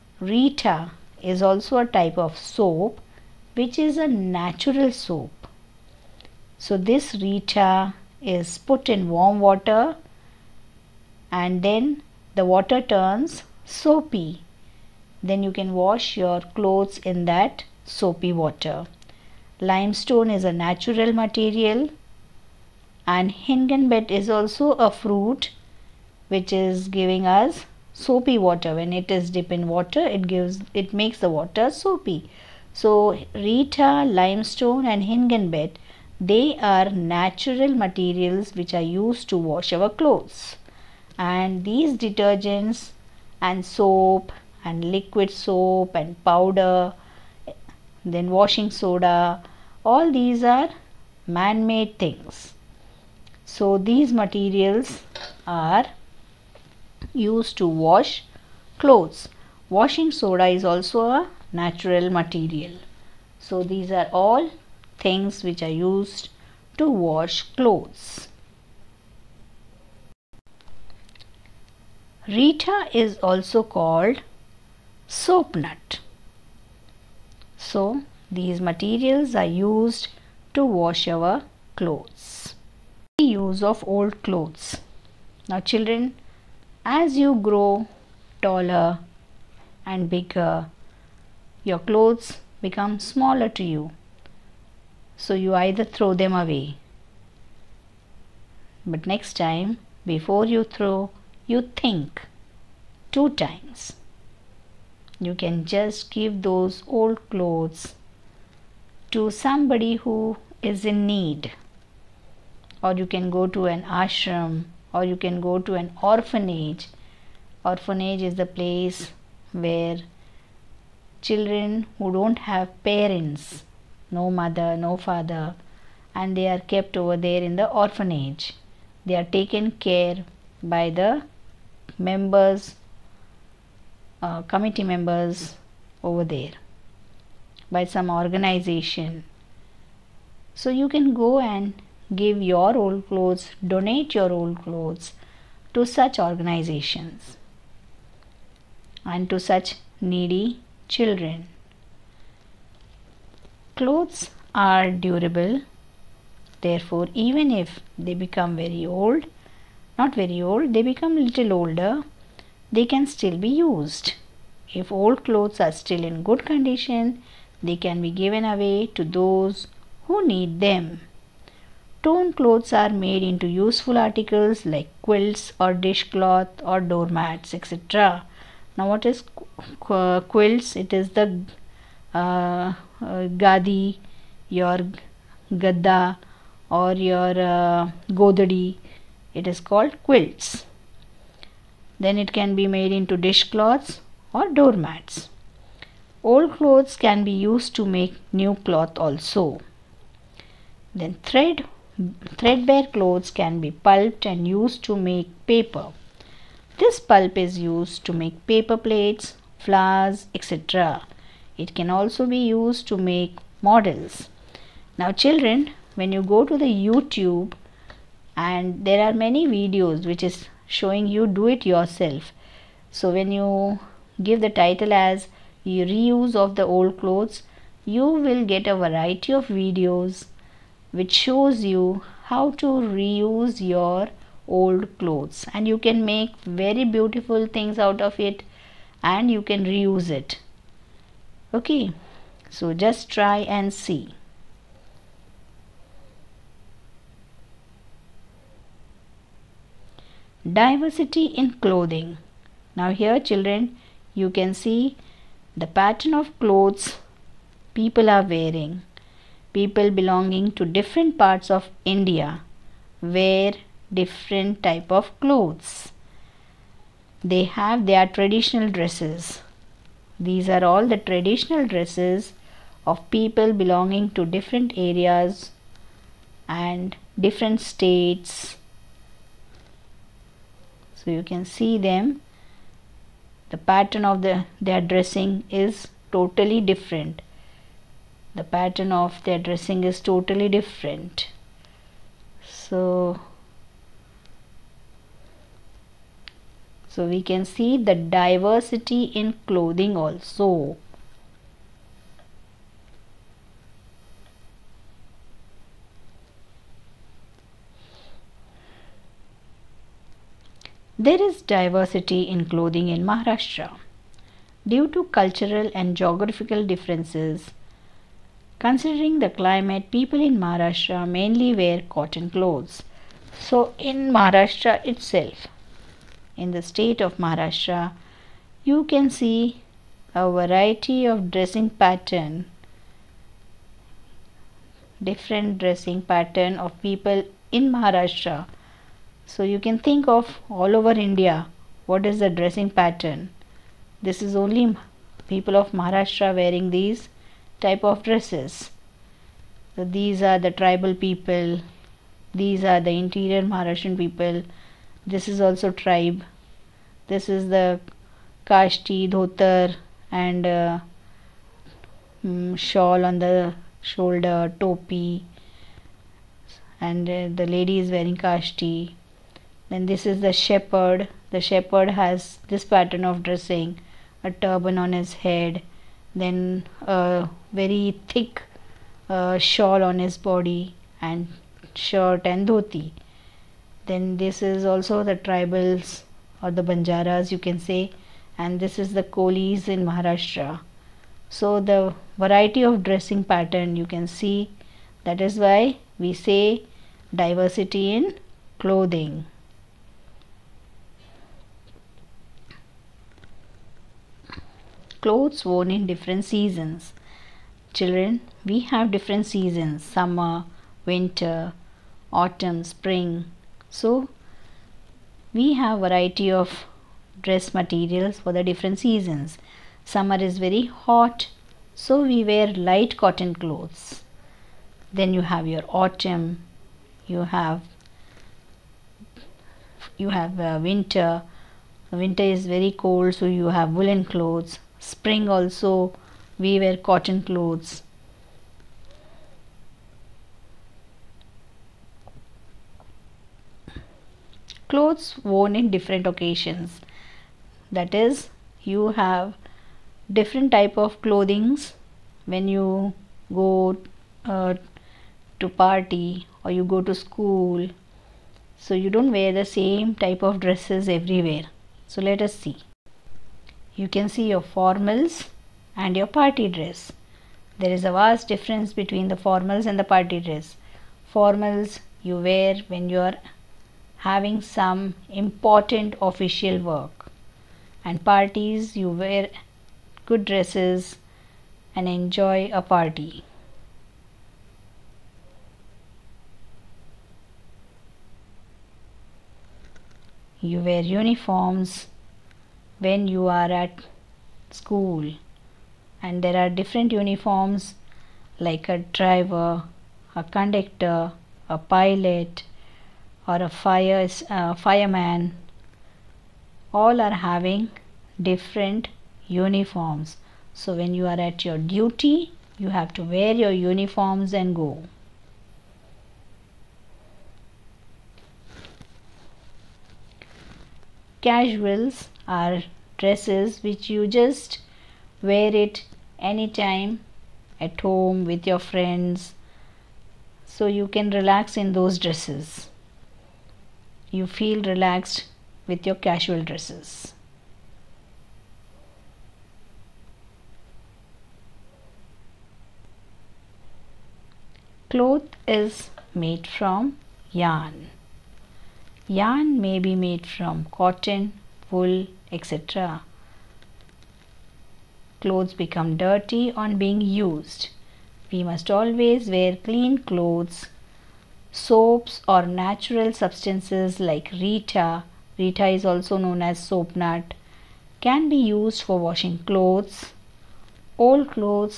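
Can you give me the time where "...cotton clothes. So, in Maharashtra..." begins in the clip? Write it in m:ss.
5:21.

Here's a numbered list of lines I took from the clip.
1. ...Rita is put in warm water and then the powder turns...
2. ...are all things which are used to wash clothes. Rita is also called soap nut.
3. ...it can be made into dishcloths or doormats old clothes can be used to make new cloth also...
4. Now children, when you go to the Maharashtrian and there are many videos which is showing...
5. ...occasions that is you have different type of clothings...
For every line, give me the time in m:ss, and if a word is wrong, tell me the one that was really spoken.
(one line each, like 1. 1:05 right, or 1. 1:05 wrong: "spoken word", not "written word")
1. 0:07 wrong: "water", not "powder"
2. 1:03 right
3. 3:12 right
4. 3:34 wrong: "YouTube", not "Maharashtrian"
5. 7:26 right.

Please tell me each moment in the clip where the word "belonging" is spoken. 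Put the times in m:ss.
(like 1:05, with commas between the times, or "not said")
4:19, 4:33.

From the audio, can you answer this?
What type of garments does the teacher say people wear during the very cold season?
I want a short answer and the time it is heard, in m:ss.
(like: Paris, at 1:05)
woolen clothes, at 7:13.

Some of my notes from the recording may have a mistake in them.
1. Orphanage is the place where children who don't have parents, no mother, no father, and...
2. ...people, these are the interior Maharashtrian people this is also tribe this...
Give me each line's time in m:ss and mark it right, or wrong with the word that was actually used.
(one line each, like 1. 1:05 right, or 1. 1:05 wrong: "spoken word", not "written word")
1. 1:57 right
2. 5:50 right.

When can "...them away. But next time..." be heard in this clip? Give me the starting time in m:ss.
1:36.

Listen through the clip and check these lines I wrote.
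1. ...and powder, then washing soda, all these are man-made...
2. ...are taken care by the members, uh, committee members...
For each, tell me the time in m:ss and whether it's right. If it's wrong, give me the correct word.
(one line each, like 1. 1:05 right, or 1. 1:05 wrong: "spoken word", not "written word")
1. 0:45 right
2. 2:09 right.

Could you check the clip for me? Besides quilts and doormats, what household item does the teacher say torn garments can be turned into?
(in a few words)
dishcloth.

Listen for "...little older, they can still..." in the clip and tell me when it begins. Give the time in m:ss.
2:41.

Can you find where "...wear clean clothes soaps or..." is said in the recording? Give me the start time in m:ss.
9:19.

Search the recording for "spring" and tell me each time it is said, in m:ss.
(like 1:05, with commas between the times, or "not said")
6:52, 7:14.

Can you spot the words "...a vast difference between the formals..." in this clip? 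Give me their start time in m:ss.
7:47.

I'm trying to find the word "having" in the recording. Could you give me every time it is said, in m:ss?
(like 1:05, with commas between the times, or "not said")
7:54, 8:27.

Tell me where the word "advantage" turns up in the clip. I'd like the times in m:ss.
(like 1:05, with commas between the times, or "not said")
not said.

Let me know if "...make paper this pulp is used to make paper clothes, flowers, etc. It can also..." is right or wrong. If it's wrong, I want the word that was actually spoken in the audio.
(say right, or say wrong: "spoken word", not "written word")
wrong: "plates", not "clothes".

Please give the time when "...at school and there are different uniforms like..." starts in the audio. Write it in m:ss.
8:13.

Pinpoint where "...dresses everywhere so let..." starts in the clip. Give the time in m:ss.
7:40.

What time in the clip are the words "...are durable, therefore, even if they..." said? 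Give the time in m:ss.
2:34.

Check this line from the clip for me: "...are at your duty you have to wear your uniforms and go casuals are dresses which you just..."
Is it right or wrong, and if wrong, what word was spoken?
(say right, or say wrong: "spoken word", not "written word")
right.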